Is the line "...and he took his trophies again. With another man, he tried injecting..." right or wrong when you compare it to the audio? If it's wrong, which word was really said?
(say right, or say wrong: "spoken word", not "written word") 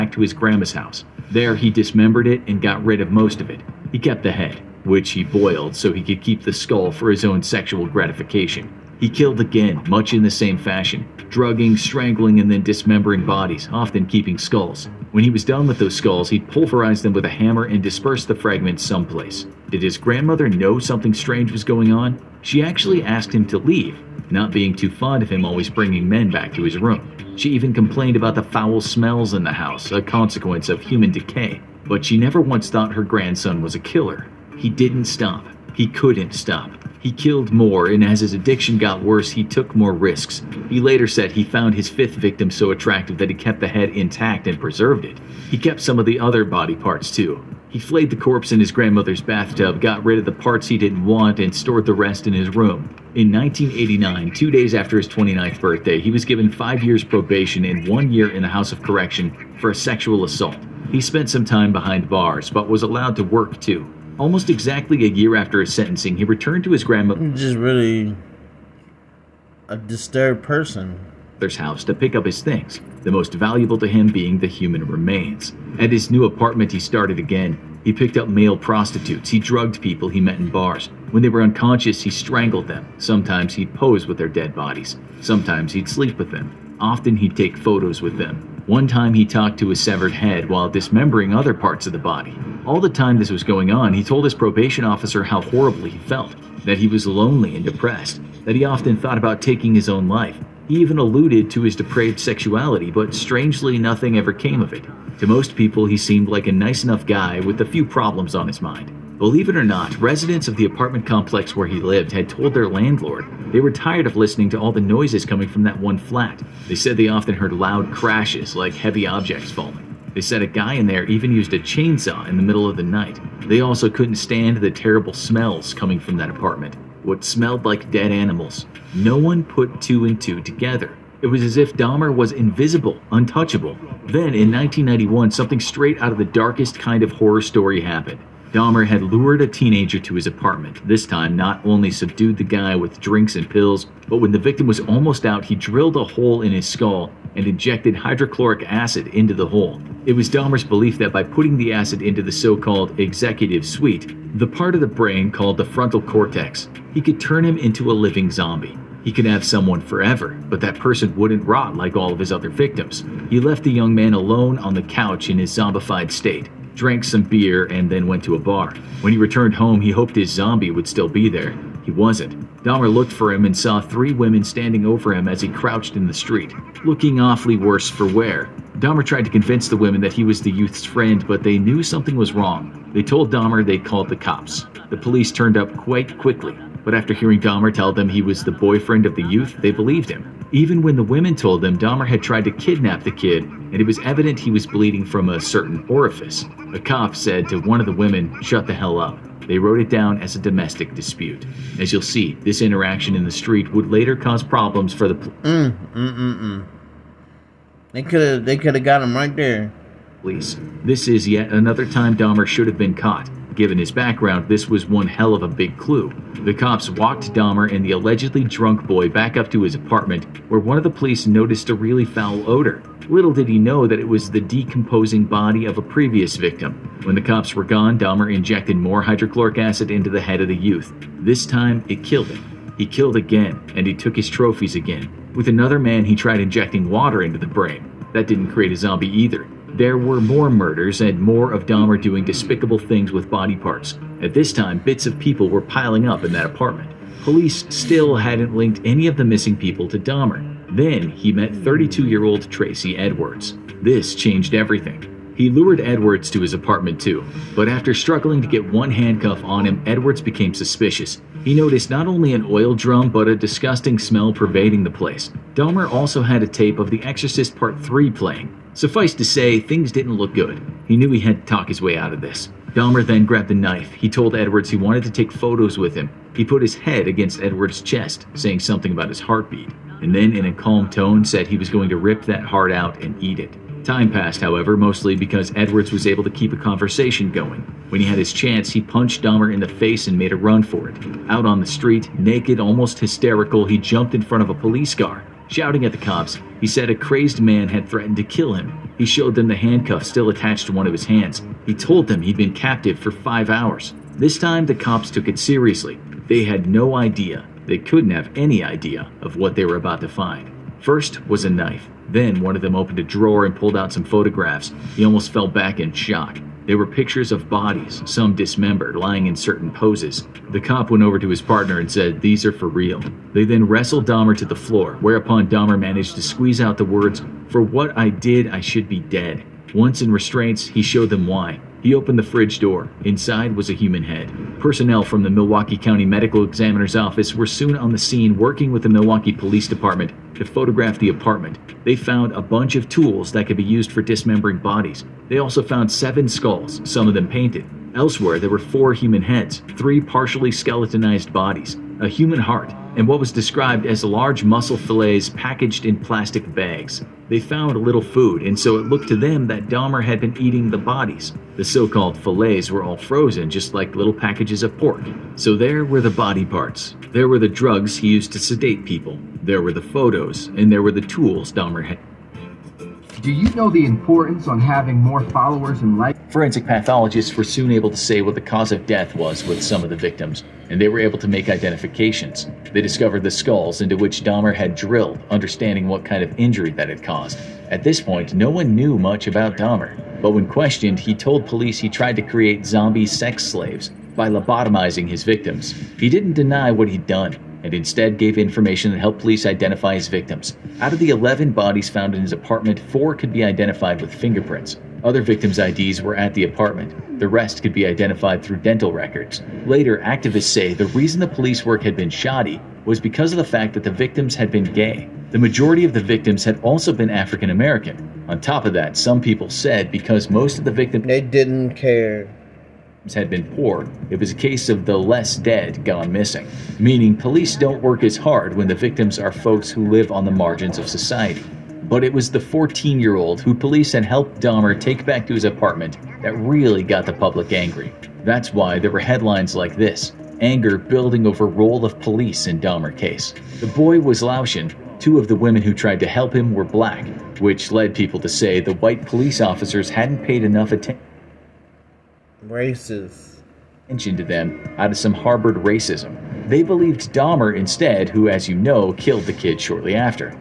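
right.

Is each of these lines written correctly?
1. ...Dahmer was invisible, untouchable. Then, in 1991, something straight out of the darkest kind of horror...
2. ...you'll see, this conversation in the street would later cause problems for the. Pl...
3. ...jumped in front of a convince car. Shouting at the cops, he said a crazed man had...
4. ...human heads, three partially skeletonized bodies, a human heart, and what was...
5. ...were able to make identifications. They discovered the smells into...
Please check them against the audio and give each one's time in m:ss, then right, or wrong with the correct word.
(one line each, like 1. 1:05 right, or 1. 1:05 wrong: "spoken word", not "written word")
1. 2:11 right
2. 3:21 wrong: "interaction", not "conversation"
3. 4:53 wrong: "police", not "convince"
4. 5:48 right
5. 6:20 wrong: "skulls", not "smells".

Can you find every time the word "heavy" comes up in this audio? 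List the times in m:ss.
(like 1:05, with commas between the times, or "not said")
1:58.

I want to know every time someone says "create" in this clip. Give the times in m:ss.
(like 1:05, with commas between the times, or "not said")
3:58, 6:32.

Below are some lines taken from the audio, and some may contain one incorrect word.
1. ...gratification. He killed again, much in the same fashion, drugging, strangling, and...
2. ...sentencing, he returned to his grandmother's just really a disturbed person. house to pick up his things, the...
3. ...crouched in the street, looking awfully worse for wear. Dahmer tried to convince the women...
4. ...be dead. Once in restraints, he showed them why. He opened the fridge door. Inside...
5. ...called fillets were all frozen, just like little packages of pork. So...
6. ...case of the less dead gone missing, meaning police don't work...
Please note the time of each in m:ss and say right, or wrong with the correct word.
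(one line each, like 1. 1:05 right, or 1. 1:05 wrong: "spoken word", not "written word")
1. 0:07 right
2. 1:05 right
3. 2:55 right
4. 5:28 right
5. 6:01 right
6. 7:04 right.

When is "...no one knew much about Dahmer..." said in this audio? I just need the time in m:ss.
6:28.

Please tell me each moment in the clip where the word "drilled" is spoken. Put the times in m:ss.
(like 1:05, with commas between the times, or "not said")
2:25, 6:24.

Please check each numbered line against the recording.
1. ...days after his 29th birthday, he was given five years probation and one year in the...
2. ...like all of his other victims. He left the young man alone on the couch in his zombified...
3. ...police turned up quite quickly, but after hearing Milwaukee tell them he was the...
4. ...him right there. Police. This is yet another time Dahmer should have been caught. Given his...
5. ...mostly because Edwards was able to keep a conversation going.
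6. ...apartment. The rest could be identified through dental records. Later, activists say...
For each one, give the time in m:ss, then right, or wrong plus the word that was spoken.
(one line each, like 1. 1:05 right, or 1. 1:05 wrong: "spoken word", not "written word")
1. 0:54 right
2. 2:41 right
3. 3:04 wrong: "Dahmer", not "Milwaukee"
4. 3:29 right
5. 4:44 right
6. 6:46 right.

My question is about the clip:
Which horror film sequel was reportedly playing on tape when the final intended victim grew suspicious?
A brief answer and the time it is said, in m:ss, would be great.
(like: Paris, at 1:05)
The Exorcist Part 3, at 4:26.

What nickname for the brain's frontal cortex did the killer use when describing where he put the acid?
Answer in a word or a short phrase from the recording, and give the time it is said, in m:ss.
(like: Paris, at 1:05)
Executive suite, at 2:32.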